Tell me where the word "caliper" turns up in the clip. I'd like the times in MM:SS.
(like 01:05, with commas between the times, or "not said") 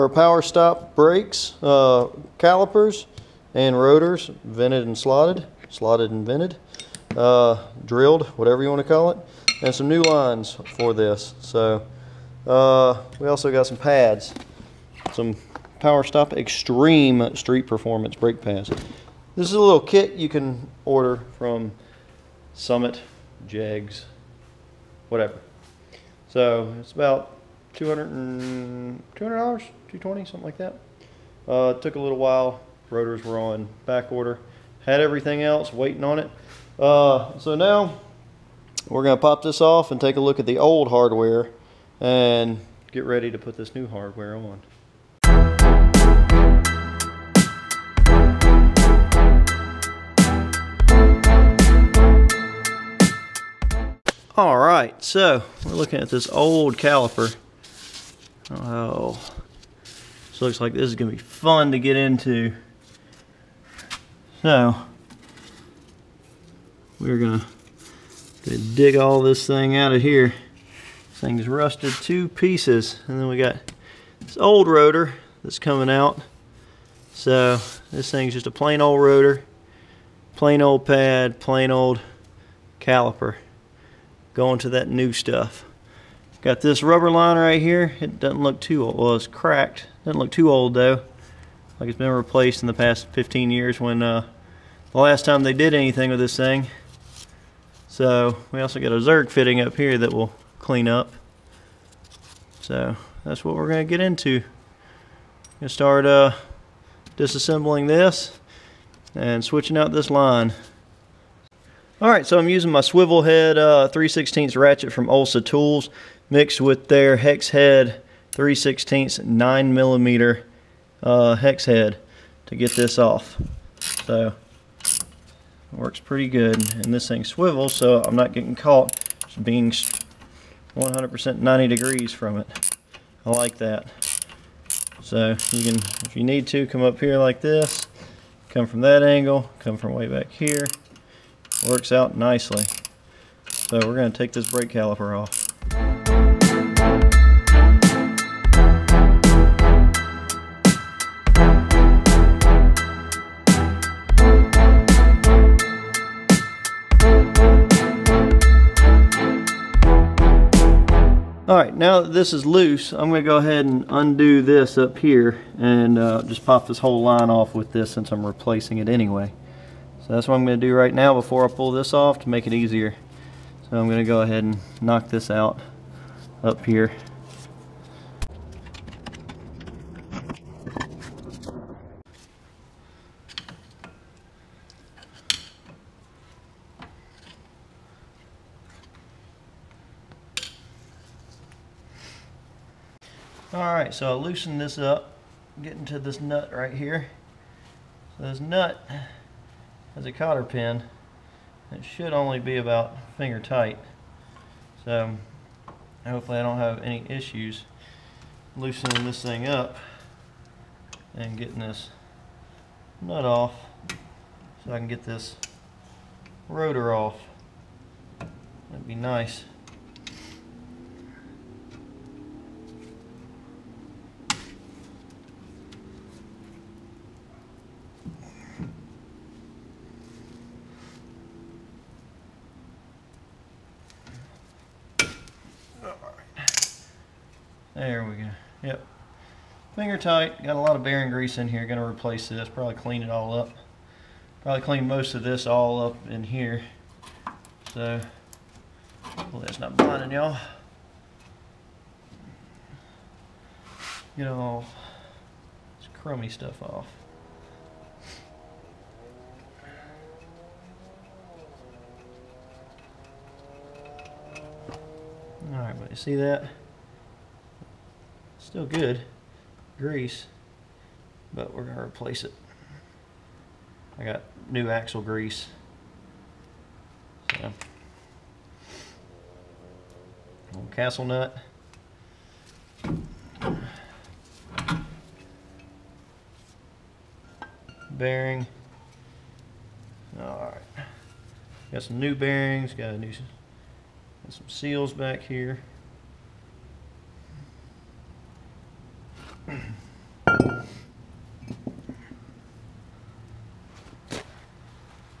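00:02, 00:56, 01:22, 02:24.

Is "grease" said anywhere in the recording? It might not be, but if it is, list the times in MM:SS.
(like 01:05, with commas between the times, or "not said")
04:01, 04:29, 04:35.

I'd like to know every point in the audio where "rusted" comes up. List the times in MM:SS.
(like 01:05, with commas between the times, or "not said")
01:11.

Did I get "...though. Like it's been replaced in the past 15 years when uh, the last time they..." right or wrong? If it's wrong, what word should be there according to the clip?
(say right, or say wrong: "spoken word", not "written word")
right.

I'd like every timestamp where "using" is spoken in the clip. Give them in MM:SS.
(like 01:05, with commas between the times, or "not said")
01:52.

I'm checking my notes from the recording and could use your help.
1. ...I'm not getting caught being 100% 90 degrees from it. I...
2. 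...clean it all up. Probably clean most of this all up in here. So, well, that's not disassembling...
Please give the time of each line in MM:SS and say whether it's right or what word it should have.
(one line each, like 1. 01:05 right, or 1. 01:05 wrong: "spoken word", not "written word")
1. 02:08 right
2. 04:02 wrong: "blinding", not "disassembling".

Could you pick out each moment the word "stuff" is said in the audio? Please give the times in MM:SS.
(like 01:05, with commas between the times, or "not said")
01:25, 04:16.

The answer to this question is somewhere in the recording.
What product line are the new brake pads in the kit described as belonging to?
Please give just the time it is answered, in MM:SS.
00:16.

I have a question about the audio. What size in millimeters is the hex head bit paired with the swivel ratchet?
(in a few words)
9 millimeter.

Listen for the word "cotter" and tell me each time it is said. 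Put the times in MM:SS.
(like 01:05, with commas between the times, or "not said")
03:20.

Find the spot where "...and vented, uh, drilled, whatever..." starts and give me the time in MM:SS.
00:06.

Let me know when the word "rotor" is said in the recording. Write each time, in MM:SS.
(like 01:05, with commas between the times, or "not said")
00:03, 00:32, 01:14, 01:18, 03:36.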